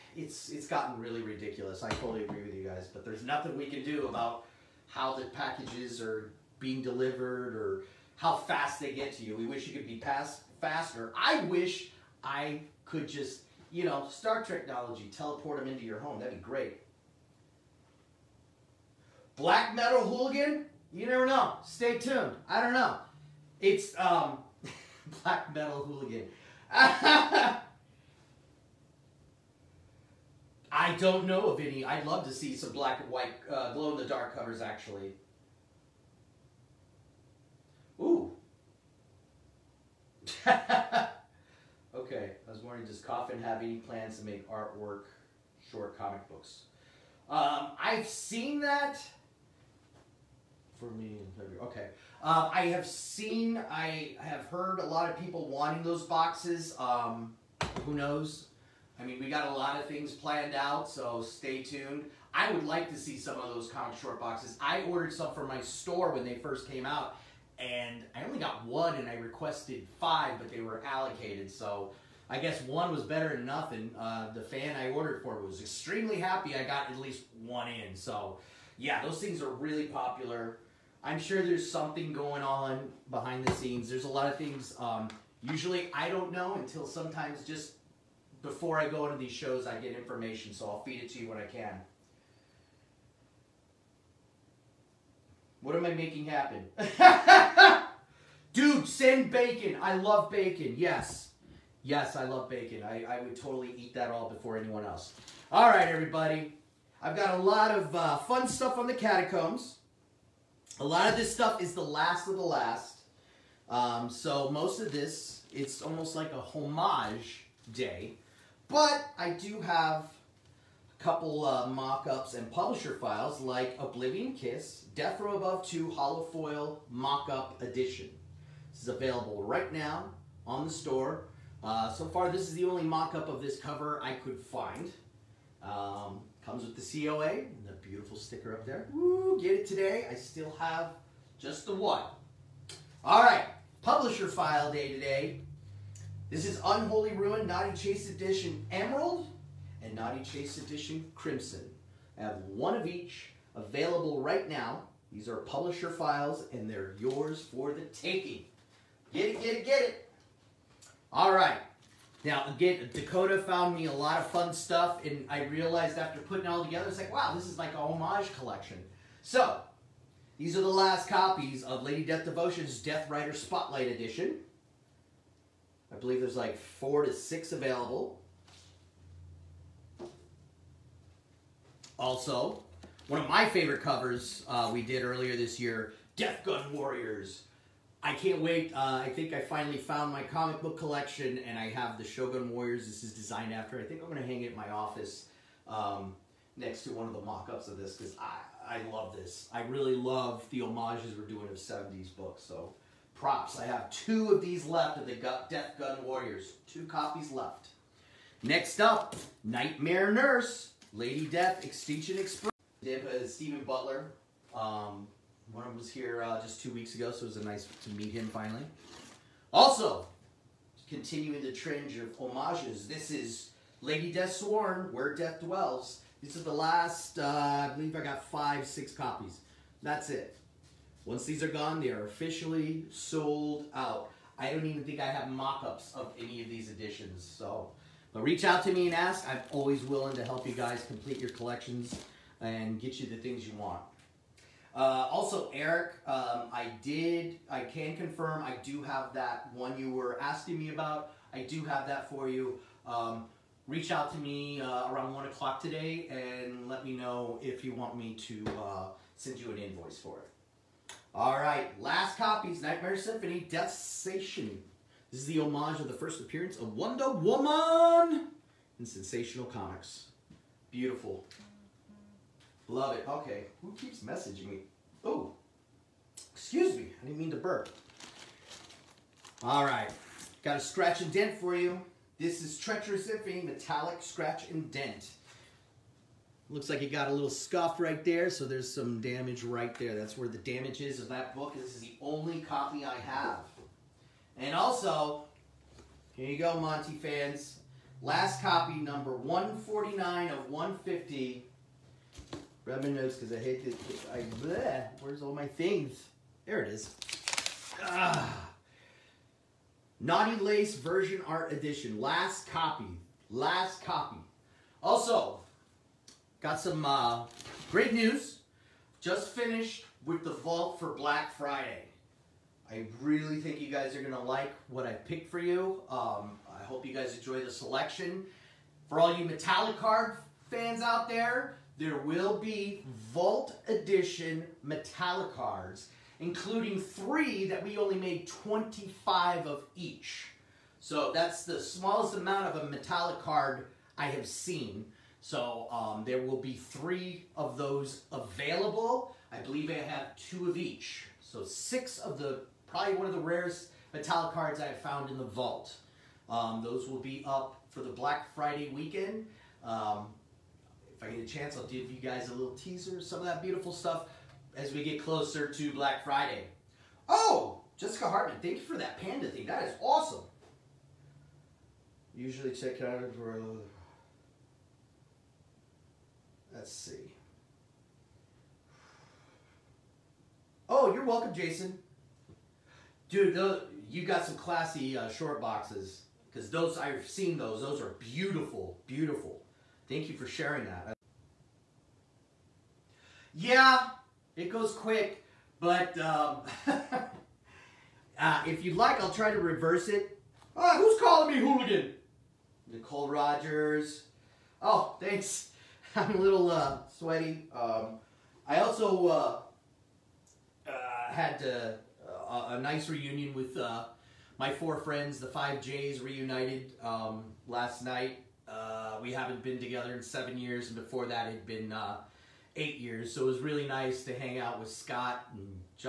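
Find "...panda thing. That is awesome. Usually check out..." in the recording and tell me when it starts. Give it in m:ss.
6:09.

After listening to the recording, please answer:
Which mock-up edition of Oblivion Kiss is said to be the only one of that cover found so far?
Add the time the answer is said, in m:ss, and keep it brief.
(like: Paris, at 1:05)
Death Row Above 2 Hollow Foil, at 2:04.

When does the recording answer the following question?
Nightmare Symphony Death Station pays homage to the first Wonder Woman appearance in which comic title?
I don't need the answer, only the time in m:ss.
4:28.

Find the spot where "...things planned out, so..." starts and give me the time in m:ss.
0:59.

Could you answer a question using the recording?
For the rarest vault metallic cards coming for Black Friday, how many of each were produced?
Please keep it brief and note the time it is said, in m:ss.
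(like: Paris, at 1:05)
25, at 5:38.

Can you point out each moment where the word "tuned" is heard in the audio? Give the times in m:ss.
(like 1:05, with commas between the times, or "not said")
0:21, 1:01.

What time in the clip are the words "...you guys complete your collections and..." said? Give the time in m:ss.
4:00.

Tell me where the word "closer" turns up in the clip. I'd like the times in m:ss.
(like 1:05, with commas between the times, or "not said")
6:05.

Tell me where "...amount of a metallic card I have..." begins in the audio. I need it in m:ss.
5:42.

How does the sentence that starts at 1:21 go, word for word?
I'm sure there's something going on behind the scenes.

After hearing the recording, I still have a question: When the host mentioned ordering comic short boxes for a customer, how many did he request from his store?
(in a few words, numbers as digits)
5.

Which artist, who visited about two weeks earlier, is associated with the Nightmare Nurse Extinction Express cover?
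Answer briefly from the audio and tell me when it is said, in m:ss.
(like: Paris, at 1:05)
Stephen Butler, at 3:33.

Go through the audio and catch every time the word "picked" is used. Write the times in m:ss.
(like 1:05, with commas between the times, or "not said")
5:24.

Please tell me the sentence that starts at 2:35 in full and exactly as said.
These are publisher files and they're yours for the taking.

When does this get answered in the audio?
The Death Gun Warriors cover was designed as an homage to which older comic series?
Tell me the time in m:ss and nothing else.
3:12.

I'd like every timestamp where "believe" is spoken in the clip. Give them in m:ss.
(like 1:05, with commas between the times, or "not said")
2:55, 3:47, 5:49.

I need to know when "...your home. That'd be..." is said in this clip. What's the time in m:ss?
0:15.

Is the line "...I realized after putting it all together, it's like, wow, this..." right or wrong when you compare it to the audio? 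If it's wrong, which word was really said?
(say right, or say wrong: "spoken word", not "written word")
right.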